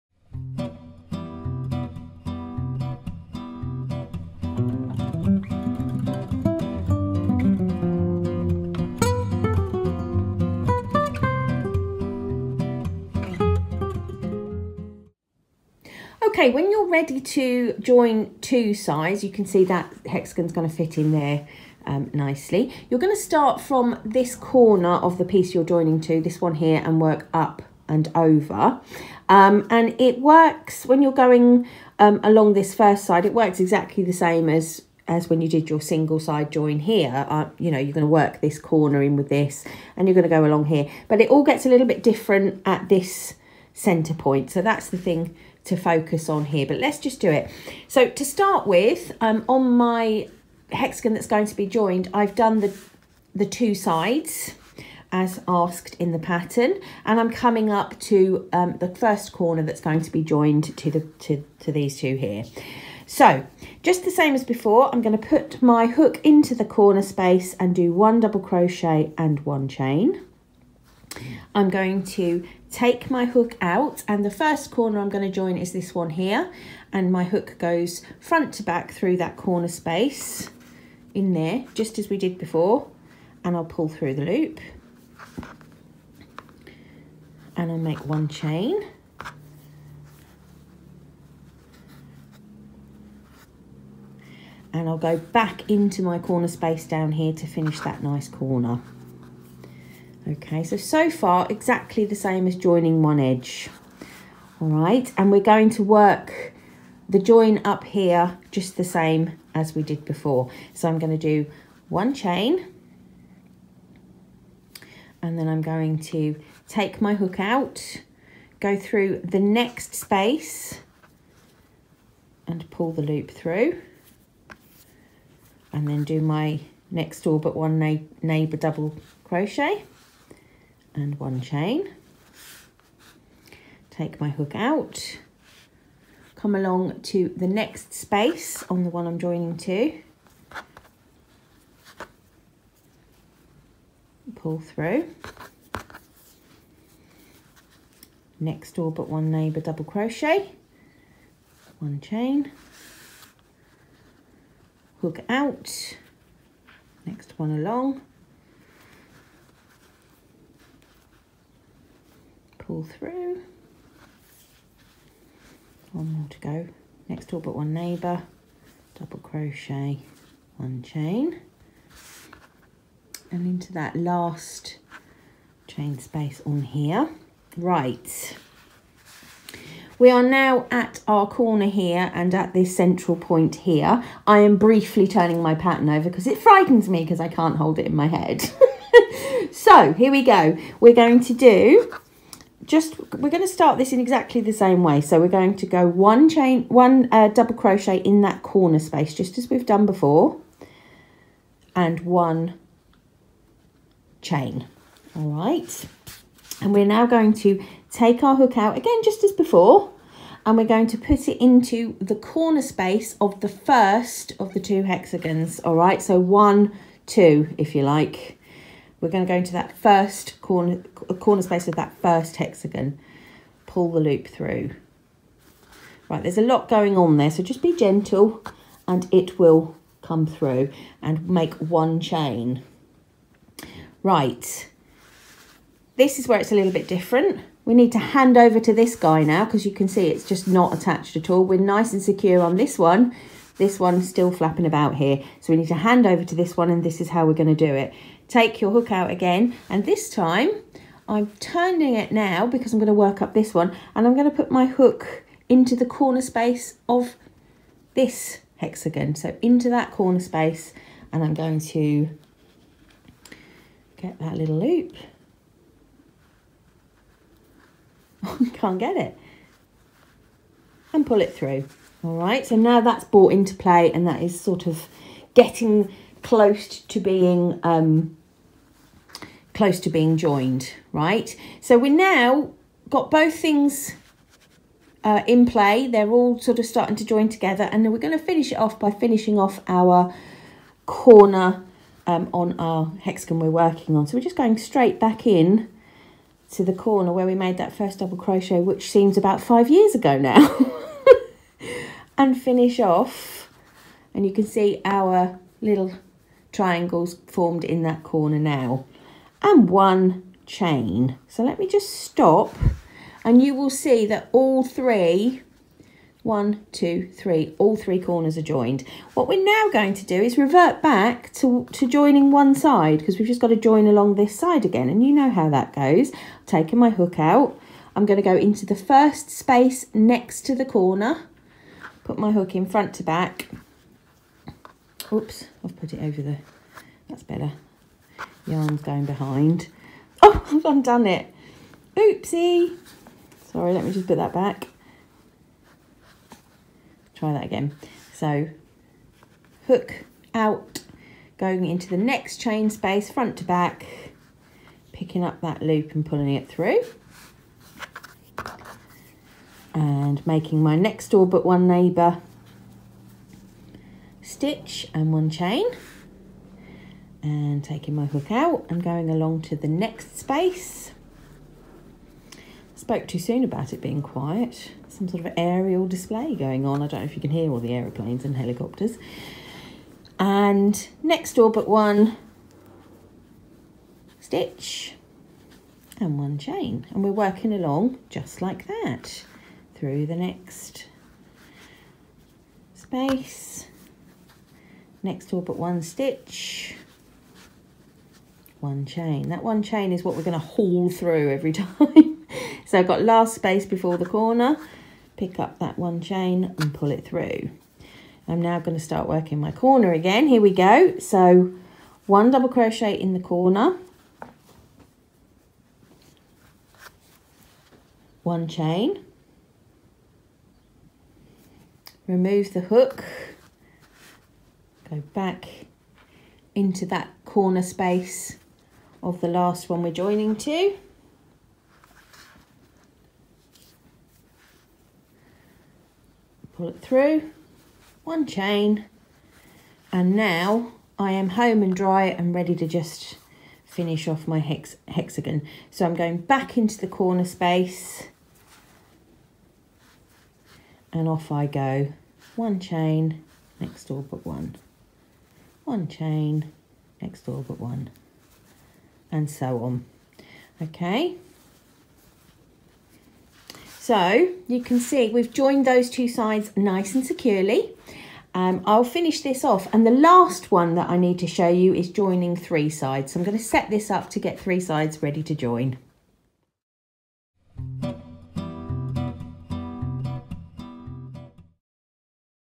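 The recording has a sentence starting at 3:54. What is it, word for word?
Right, this is where it's a little bit different.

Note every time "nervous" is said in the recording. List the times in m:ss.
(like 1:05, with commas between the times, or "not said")
not said.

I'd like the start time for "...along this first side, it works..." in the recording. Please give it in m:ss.
0:32.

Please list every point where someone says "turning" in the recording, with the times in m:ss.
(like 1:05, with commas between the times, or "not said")
3:05, 4:11.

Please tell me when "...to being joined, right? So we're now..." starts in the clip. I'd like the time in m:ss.
4:39.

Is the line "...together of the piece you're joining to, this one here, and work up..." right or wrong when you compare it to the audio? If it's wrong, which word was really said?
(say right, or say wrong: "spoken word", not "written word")
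wrong: "corner", not "together".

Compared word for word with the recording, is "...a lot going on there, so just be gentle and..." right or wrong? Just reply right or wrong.
right.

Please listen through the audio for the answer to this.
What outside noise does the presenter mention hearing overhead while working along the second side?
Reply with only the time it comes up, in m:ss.
6:17.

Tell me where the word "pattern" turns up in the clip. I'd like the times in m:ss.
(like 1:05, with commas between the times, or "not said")
0:56, 3:05.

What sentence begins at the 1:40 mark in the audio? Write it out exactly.
Okay, so, so far exactly the same as joining one edge.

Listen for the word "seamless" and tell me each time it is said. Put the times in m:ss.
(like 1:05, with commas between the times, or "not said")
not said.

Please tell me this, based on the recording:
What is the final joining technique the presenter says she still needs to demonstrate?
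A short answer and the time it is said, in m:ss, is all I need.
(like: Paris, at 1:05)
Joining three sides, at 7:51.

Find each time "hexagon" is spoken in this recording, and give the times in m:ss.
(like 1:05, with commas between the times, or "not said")
0:20, 0:50, 3:34, 3:42, 4:18, 4:53, 7:24.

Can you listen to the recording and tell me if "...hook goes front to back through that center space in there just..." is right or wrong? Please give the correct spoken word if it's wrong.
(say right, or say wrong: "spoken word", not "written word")
wrong: "corner", not "center".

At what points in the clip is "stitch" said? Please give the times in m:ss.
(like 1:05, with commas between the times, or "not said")
6:04, 6:24, 6:35.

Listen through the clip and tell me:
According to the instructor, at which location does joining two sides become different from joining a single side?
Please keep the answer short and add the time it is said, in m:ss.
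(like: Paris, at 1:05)
Center point, at 0:43.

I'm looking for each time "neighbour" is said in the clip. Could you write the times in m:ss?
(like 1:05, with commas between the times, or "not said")
2:08, 2:29, 2:47, 6:01.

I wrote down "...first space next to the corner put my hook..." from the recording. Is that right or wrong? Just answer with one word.
right.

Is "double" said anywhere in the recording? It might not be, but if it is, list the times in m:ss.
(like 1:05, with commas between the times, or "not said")
1:08, 2:08, 2:29, 2:48, 3:17, 4:57, 6:52.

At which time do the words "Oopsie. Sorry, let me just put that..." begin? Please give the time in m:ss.
5:41.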